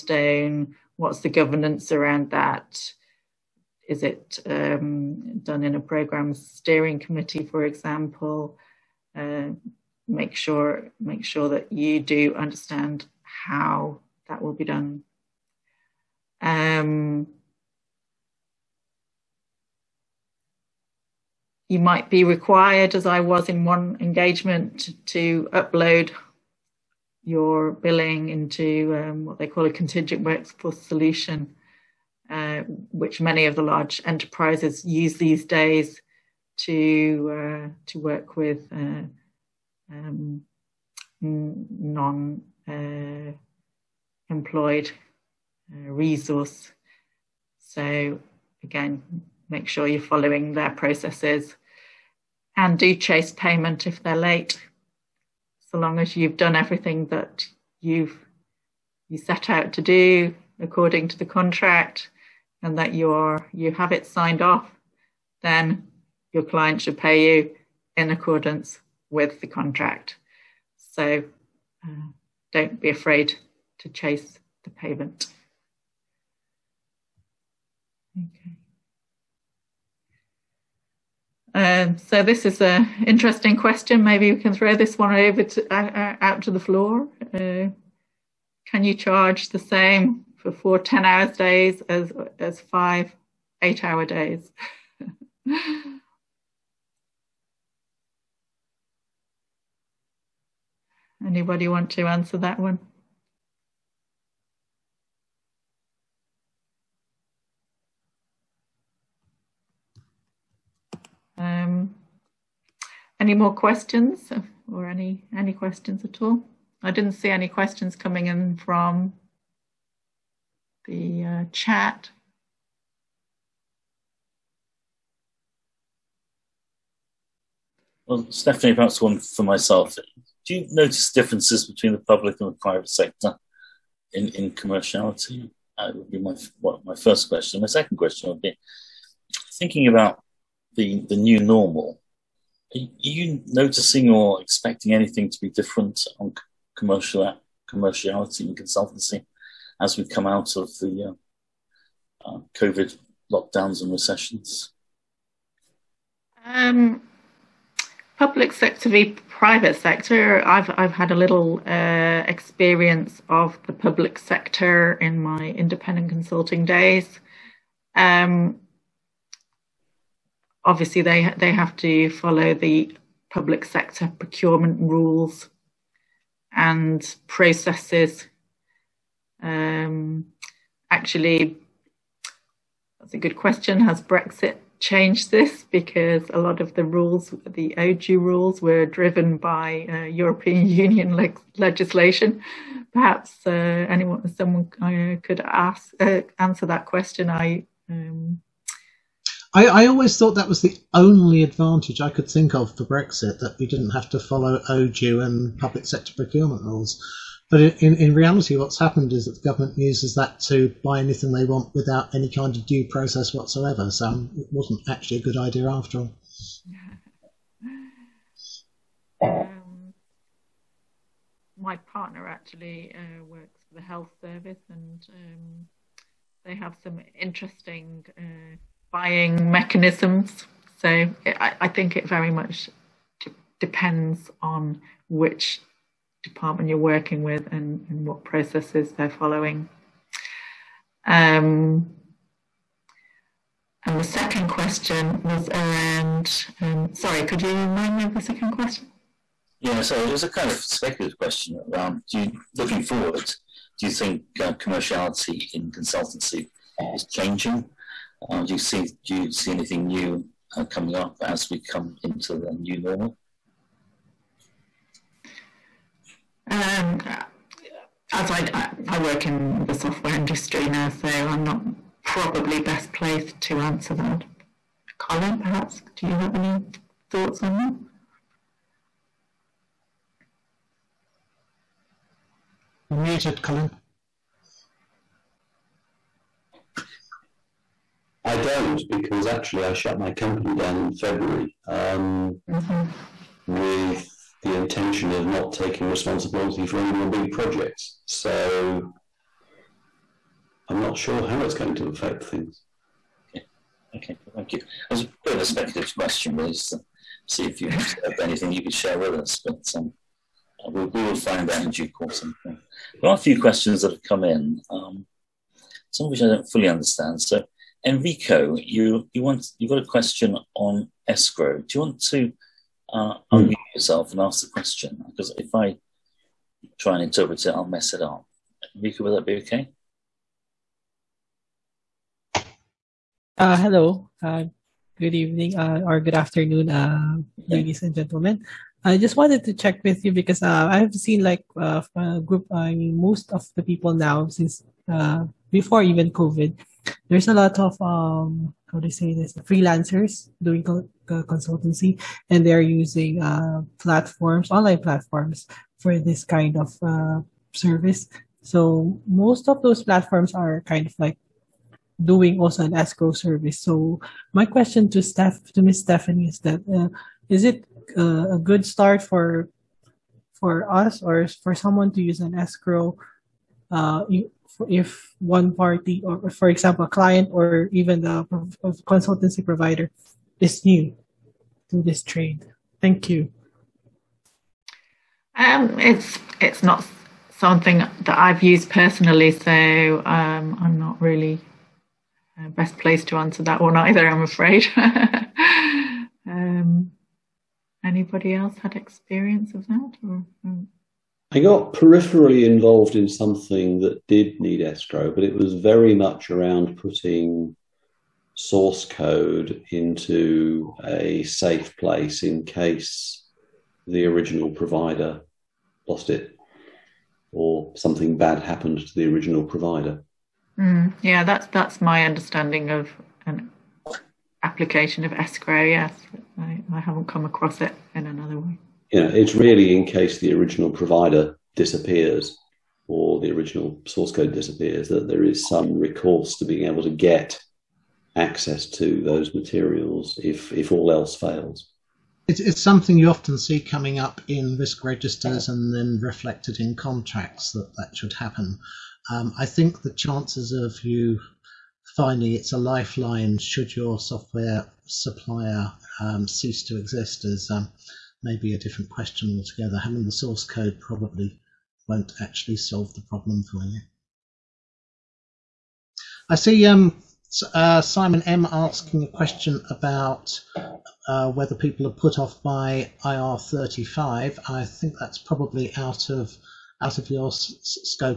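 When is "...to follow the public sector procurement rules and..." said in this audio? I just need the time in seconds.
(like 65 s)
171 s.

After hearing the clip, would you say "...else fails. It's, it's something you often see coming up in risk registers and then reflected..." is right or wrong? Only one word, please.
right.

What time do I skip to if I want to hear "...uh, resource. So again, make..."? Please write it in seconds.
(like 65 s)
45 s.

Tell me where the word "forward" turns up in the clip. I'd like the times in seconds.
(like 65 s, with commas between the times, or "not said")
252 s.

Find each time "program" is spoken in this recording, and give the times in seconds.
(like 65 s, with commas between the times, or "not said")
5 s.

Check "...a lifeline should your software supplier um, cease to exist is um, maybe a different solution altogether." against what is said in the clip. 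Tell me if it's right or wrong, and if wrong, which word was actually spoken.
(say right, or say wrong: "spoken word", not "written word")
wrong: "question", not "solution".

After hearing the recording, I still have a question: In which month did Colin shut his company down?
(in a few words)
February.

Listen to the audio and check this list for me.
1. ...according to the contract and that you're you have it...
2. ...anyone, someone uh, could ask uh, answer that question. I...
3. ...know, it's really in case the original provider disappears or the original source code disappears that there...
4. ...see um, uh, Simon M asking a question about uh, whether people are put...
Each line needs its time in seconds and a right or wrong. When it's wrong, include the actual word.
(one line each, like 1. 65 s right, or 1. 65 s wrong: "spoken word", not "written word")
1. 60 s right
2. 193 s right
3. 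429 s right
4. 466 s right.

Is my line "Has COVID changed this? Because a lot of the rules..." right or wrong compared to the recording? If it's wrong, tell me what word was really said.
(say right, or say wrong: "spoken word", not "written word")
wrong: "Brexit", not "COVID".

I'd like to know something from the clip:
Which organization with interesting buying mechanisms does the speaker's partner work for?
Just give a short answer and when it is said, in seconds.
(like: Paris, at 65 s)
the health service, at 223 s.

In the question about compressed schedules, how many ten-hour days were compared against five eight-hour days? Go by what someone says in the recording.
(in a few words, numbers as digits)
4.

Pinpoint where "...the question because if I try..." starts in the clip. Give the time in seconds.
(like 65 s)
324 s.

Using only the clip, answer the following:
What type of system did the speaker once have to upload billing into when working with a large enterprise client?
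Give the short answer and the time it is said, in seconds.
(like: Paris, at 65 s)
contingent workforce solution, at 29 s.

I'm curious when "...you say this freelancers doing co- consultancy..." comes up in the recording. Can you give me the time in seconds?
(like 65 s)
348 s.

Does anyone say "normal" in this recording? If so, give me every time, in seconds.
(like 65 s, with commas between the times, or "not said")
141 s, 262 s.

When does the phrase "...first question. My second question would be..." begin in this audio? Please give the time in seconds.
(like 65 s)
136 s.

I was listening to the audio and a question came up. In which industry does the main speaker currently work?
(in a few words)
software industry.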